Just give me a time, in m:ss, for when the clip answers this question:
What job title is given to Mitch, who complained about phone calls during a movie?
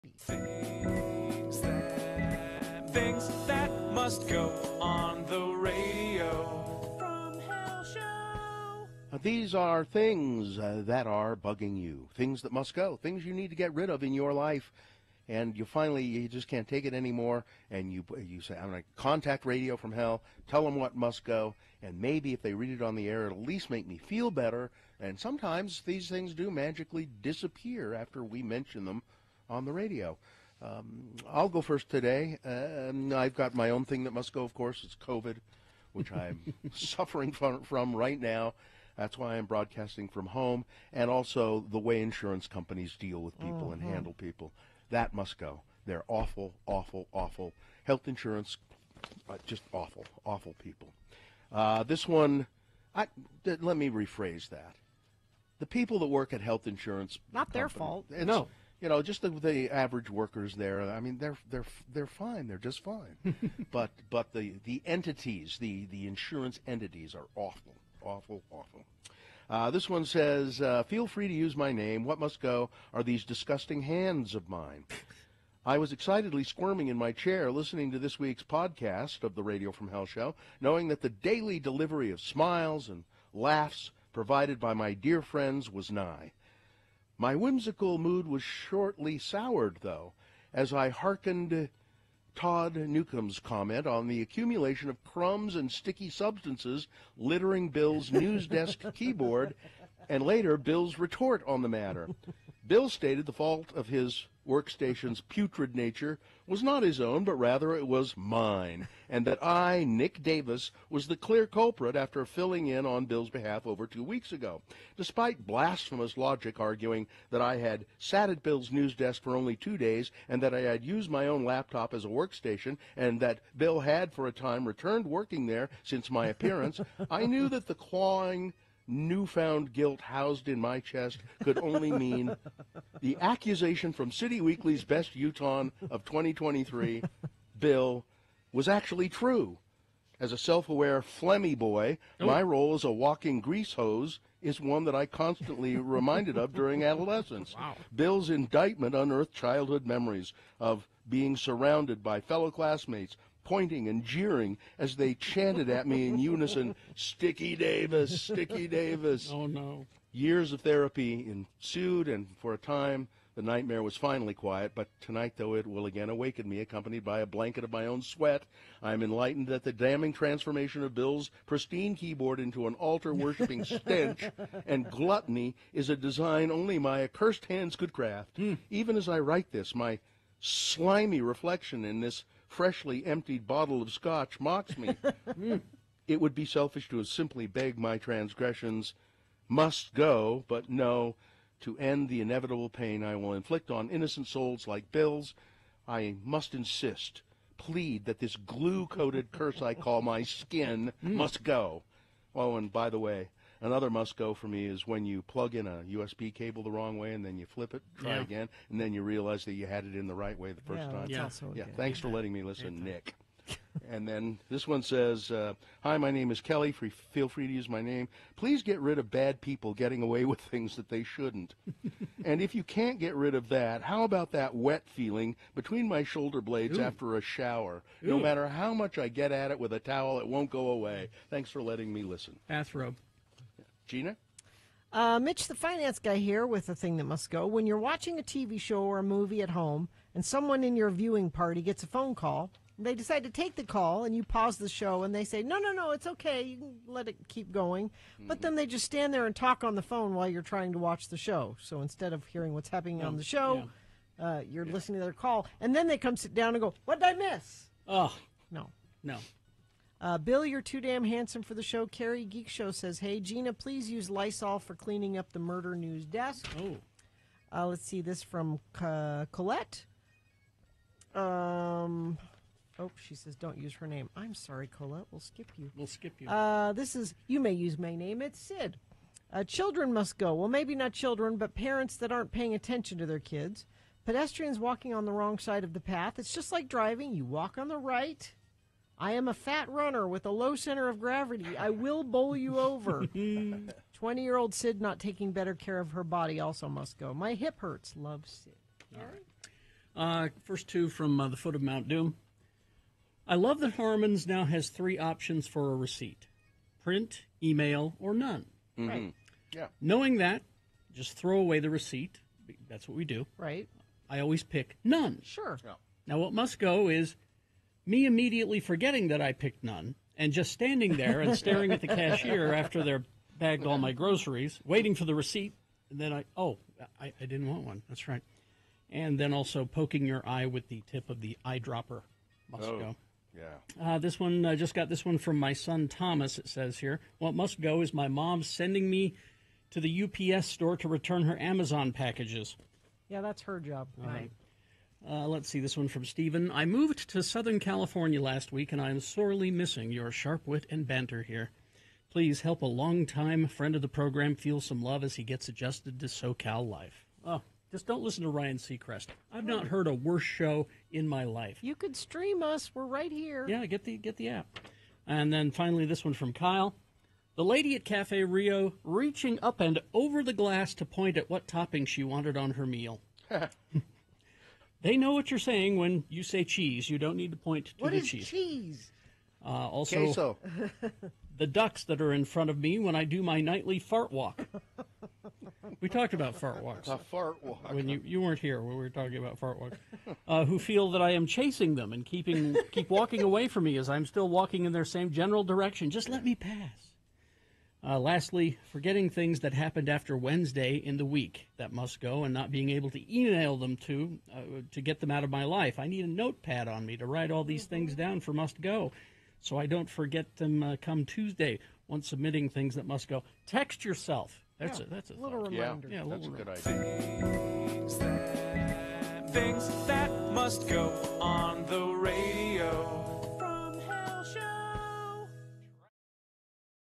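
3:55.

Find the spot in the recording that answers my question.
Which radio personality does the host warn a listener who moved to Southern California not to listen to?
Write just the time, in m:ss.
5:58.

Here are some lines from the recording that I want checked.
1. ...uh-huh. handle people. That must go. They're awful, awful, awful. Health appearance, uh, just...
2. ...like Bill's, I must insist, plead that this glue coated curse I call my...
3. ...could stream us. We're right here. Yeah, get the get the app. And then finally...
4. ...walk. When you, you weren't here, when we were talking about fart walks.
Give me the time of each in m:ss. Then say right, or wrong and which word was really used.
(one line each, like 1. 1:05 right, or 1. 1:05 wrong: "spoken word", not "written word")
1. 0:43 wrong: "insurance", not "appearance"
2. 3:14 right
3. 6:01 right
4. 6:27 right.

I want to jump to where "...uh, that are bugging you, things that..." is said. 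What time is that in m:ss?
0:10.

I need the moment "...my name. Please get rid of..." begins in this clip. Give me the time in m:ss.
3:37.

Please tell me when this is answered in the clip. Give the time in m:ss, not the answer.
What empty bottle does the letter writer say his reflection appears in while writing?
3:03.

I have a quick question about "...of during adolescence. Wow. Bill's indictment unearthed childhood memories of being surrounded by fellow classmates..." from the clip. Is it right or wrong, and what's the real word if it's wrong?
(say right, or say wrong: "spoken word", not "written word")
right.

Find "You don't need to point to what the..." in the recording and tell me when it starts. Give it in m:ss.
6:16.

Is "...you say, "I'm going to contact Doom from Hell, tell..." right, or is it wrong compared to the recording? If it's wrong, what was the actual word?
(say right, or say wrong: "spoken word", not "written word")
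wrong: "Radio", not "Doom".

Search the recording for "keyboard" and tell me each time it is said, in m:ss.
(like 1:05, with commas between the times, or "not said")
1:38, 2:51.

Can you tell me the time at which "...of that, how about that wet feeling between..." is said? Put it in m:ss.
3:43.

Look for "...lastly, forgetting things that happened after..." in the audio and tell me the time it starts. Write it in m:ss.
6:37.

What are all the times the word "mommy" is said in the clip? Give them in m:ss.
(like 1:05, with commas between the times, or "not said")
not said.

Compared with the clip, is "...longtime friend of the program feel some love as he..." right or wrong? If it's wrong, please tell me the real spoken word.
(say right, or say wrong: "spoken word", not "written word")
right.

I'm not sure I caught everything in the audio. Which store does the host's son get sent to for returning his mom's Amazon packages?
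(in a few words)
UPS store.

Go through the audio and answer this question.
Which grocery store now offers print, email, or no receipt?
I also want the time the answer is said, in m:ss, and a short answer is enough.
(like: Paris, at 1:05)
Harmon's, at 5:03.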